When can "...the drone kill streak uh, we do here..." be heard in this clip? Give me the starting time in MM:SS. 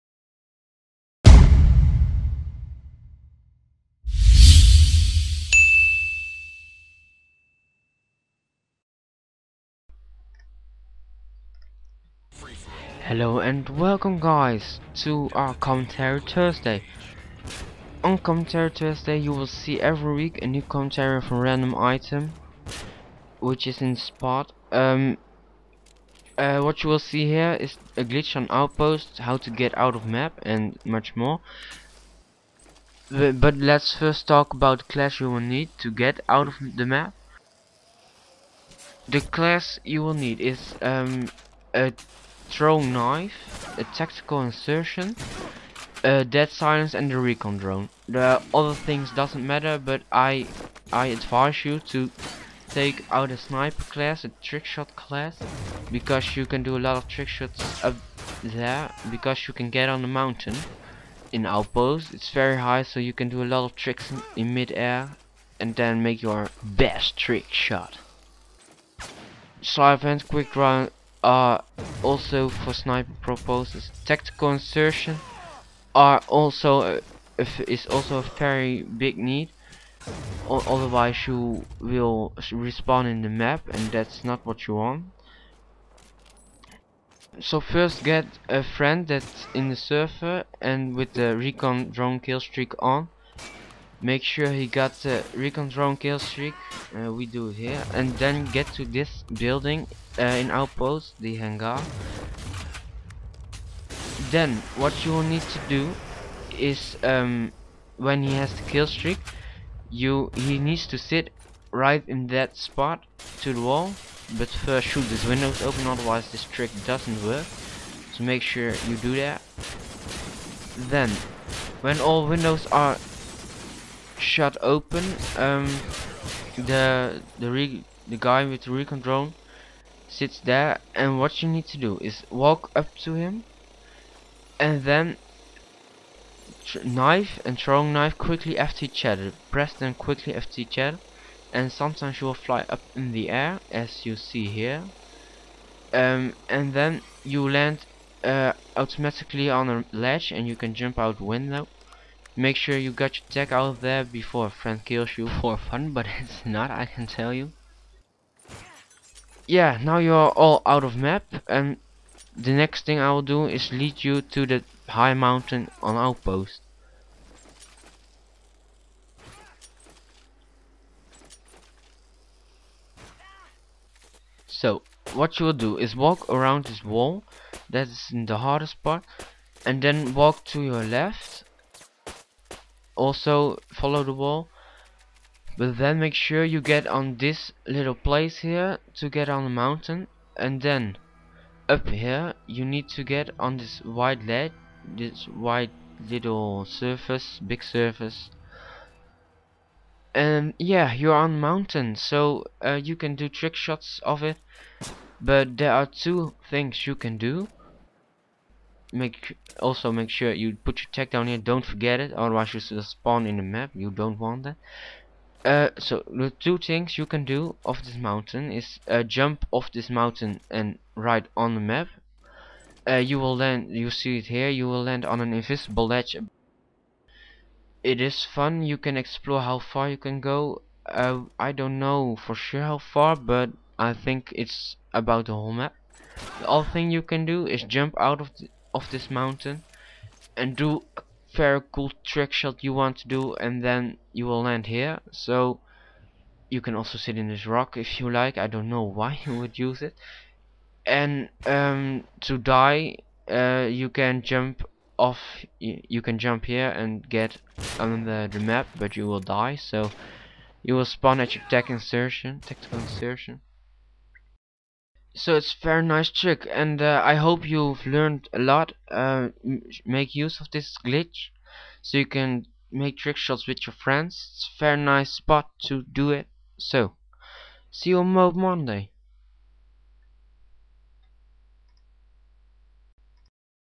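01:35.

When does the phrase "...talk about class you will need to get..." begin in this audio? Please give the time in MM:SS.
00:34.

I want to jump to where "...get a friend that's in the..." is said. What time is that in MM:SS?
01:28.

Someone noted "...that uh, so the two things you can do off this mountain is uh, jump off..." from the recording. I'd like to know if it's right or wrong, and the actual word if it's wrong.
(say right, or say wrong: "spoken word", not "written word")
right.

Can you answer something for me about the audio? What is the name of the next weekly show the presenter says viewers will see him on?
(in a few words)
Mode Monday.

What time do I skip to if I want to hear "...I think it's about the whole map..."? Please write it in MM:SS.
03:53.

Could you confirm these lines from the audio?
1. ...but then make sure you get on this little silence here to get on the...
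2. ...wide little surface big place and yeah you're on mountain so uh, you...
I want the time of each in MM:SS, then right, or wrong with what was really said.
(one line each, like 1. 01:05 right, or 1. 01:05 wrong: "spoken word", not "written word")
1. 03:05 wrong: "place", not "silence"
2. 03:15 wrong: "surface", not "place".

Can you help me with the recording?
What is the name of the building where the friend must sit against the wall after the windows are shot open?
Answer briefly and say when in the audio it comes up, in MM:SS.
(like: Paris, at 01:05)
The hangar, at 01:41.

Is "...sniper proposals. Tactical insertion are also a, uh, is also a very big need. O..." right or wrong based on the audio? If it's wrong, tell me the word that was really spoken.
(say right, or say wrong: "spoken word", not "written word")
right.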